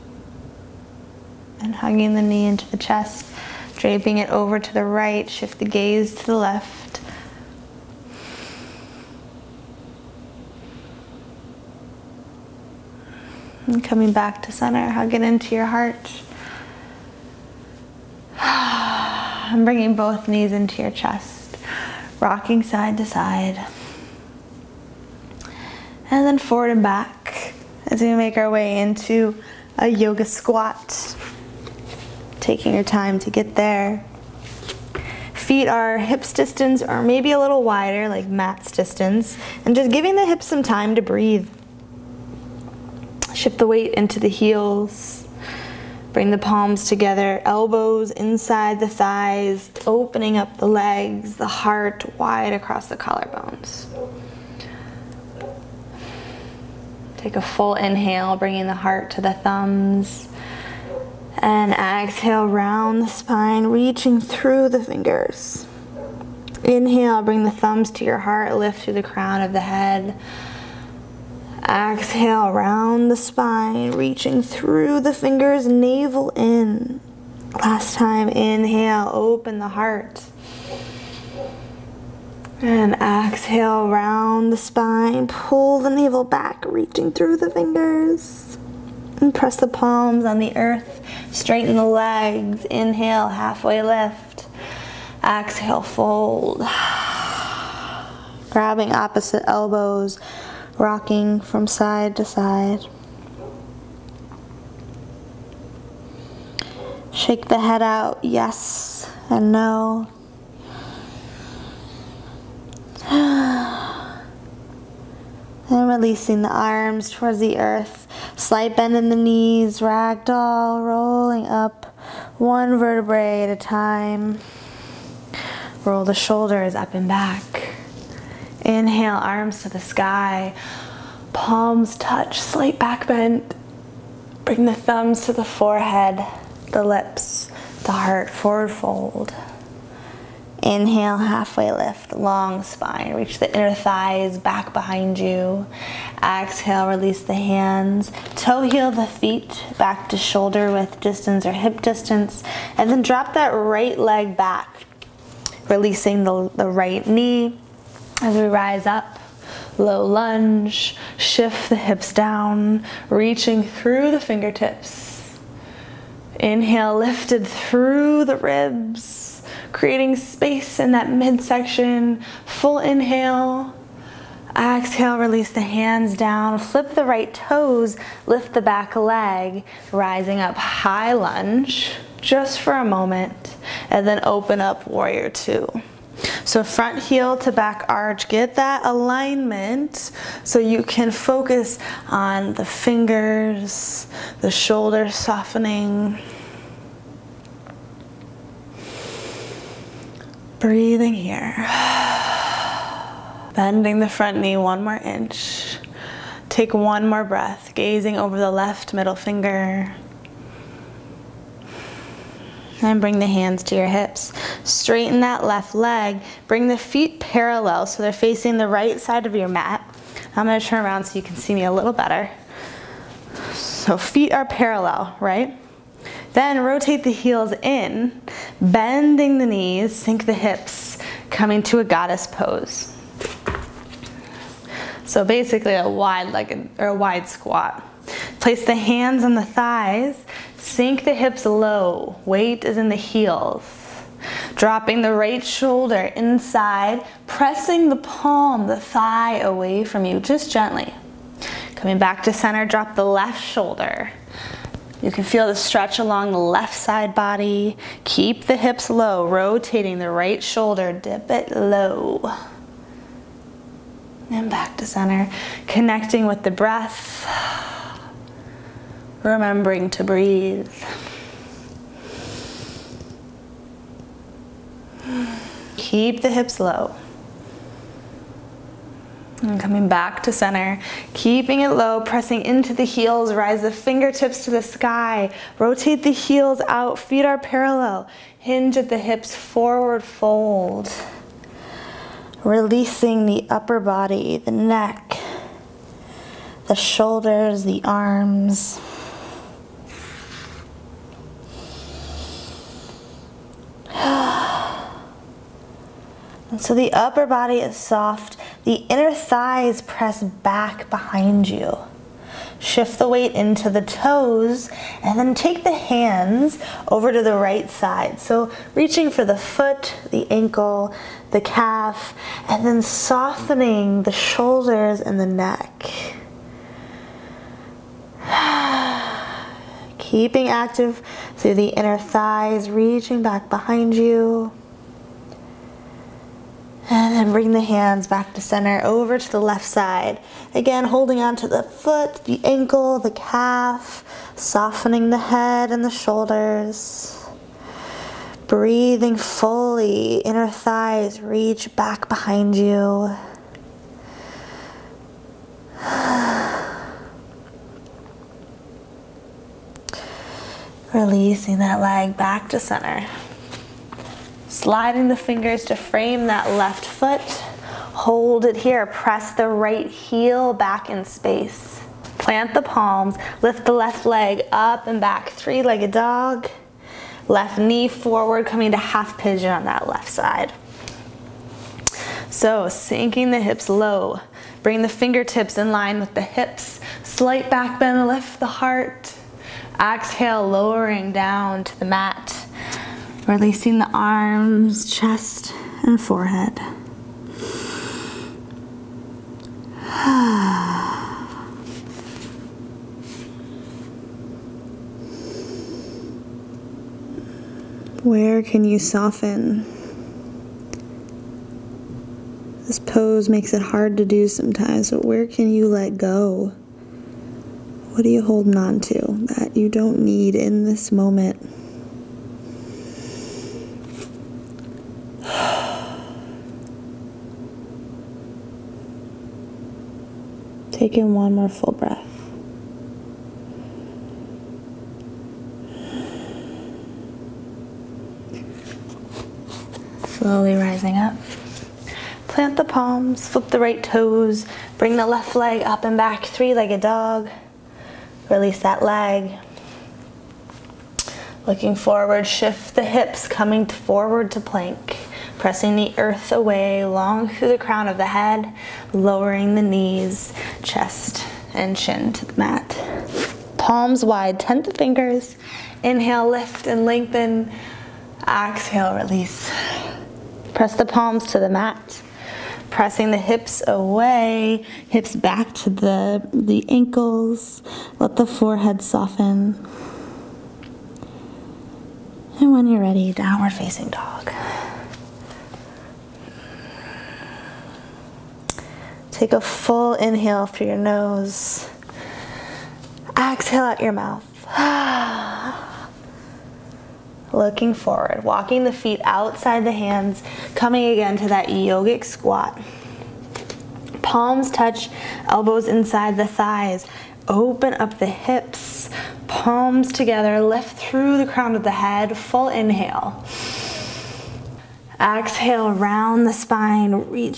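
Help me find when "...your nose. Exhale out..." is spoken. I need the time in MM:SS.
08:10.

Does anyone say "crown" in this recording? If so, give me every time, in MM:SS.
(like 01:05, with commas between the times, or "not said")
01:09, 07:37, 08:31.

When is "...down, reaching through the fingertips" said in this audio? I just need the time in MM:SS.
02:42.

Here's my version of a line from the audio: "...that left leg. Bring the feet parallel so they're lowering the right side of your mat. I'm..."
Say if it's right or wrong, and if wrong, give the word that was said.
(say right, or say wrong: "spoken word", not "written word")
wrong: "facing", not "lowering".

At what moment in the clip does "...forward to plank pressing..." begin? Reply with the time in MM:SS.
07:33.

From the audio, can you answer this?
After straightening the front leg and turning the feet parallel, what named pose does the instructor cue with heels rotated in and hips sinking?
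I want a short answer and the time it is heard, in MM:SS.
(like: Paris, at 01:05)
Goddess pose, at 03:51.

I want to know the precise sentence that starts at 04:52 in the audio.
Releasing the upper body, the neck, the shoulders, the arms.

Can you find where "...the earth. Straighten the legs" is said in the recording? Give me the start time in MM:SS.
01:30.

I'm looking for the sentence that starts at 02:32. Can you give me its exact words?
And then drop that right leg back, releasing the, the right knee as we rise up.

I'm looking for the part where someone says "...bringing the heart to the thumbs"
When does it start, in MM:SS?
00:58.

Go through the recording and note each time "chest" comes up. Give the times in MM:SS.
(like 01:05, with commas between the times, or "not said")
00:02, 00:20, 06:34, 07:40.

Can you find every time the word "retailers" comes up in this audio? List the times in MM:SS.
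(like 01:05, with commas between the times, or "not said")
not said.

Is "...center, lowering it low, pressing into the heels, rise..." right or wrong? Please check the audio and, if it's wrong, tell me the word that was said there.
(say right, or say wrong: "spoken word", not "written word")
wrong: "keeping", not "lowering".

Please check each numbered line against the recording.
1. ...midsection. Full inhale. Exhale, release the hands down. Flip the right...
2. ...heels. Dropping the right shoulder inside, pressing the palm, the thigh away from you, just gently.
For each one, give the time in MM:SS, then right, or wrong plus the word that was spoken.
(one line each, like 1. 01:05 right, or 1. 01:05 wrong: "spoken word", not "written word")
1. 02:51 right
2. 04:02 right.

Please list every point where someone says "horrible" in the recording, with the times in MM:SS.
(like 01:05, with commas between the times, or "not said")
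not said.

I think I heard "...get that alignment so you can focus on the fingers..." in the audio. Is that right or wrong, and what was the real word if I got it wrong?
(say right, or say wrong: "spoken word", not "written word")
right.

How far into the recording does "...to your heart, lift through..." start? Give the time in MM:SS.
01:07.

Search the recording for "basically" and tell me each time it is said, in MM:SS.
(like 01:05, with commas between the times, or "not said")
03:55.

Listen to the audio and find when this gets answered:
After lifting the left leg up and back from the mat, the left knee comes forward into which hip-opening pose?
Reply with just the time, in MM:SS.
06:18.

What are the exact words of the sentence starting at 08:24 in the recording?
Palms touch, elbows inside the thighs.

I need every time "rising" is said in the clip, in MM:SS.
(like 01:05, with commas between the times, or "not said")
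02:59, 07:20.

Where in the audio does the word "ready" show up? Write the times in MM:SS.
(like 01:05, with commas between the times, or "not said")
08:02.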